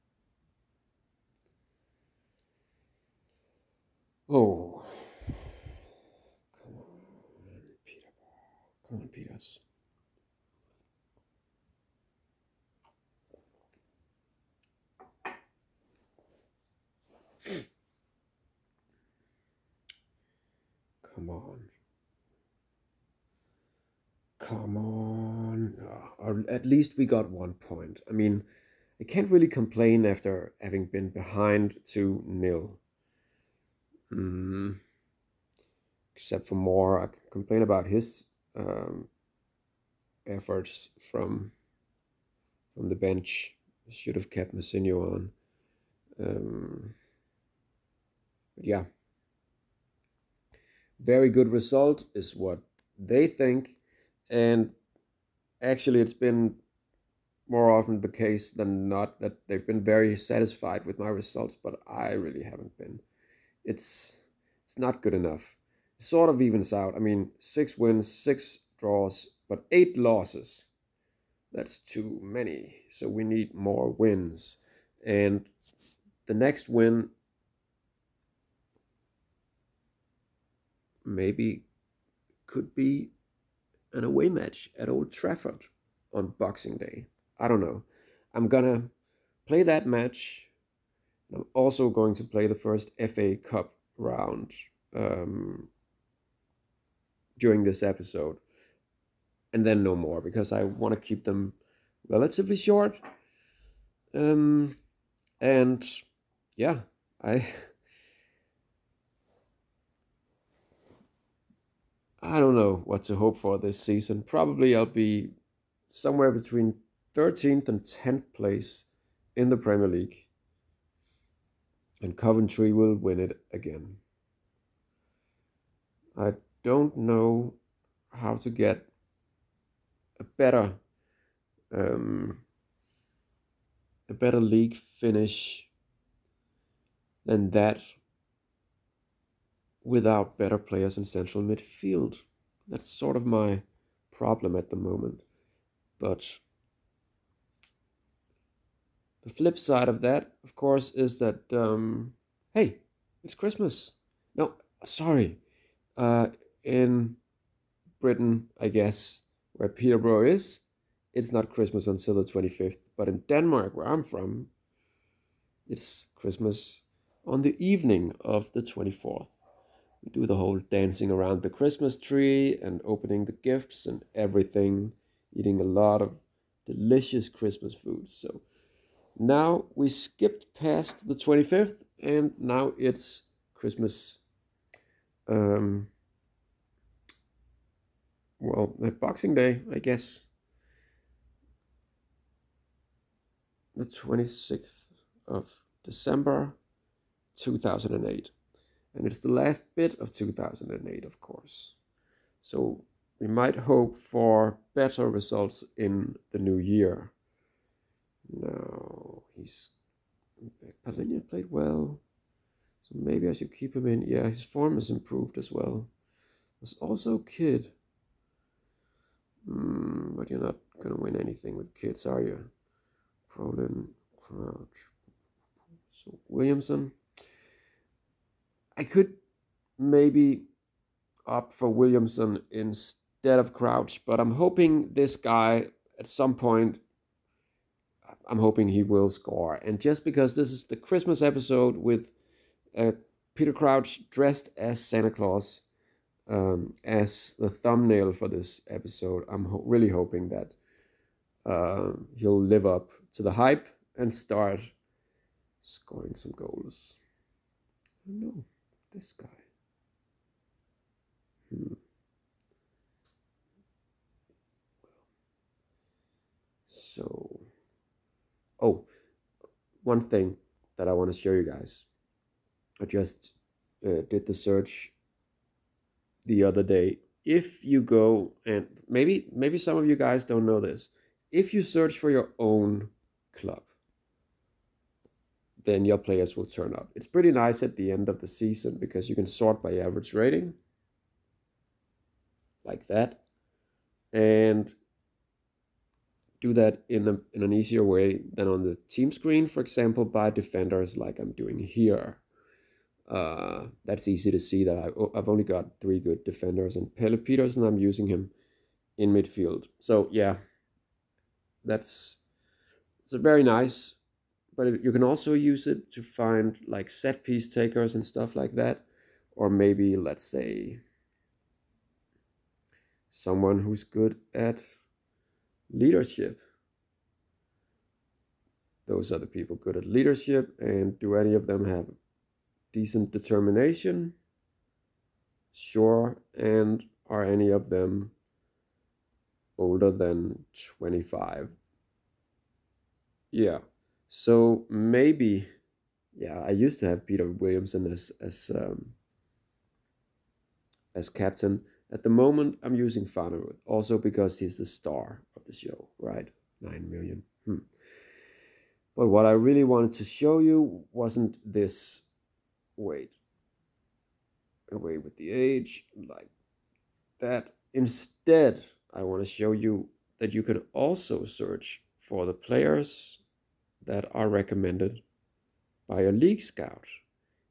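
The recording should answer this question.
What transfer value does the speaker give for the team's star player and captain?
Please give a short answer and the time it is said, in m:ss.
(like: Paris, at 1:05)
9 million, at 5:56.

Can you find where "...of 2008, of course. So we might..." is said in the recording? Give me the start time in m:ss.
3:19.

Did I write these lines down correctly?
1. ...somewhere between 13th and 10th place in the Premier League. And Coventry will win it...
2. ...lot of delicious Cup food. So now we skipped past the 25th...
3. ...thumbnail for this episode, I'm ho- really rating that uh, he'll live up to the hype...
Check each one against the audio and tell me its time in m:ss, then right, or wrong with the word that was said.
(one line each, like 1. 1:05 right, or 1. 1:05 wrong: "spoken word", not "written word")
1. 1:55 right
2. 2:55 wrong: "Christmas", not "Cup"
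3. 4:07 wrong: "hoping", not "rating".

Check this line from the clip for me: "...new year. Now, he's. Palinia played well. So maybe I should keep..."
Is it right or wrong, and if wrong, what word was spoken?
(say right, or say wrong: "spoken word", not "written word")
right.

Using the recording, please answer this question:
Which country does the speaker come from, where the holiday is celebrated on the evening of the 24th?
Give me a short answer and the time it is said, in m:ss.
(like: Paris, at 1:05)
Denmark, at 2:43.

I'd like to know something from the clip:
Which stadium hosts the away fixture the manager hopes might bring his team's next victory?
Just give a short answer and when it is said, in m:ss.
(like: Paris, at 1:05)
Old Trafford, at 1:24.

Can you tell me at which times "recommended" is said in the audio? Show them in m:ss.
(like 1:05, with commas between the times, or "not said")
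6:14.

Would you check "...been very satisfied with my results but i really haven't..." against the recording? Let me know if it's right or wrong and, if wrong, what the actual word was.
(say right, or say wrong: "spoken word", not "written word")
right.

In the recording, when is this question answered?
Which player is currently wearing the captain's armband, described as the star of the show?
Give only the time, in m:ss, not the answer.
5:53.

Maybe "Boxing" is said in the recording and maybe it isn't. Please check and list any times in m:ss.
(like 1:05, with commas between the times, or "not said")
1:26, 3:08.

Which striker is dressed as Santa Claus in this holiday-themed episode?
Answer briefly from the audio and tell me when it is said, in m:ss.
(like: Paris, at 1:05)
Peter Crouch, at 4:03.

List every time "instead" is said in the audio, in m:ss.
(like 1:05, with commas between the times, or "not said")
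3:52, 6:07.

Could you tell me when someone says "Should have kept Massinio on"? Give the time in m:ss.
0:43.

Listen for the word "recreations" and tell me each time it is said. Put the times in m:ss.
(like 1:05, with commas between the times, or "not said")
not said.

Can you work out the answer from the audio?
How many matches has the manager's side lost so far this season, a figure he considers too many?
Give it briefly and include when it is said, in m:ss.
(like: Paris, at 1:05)
8, at 1:09.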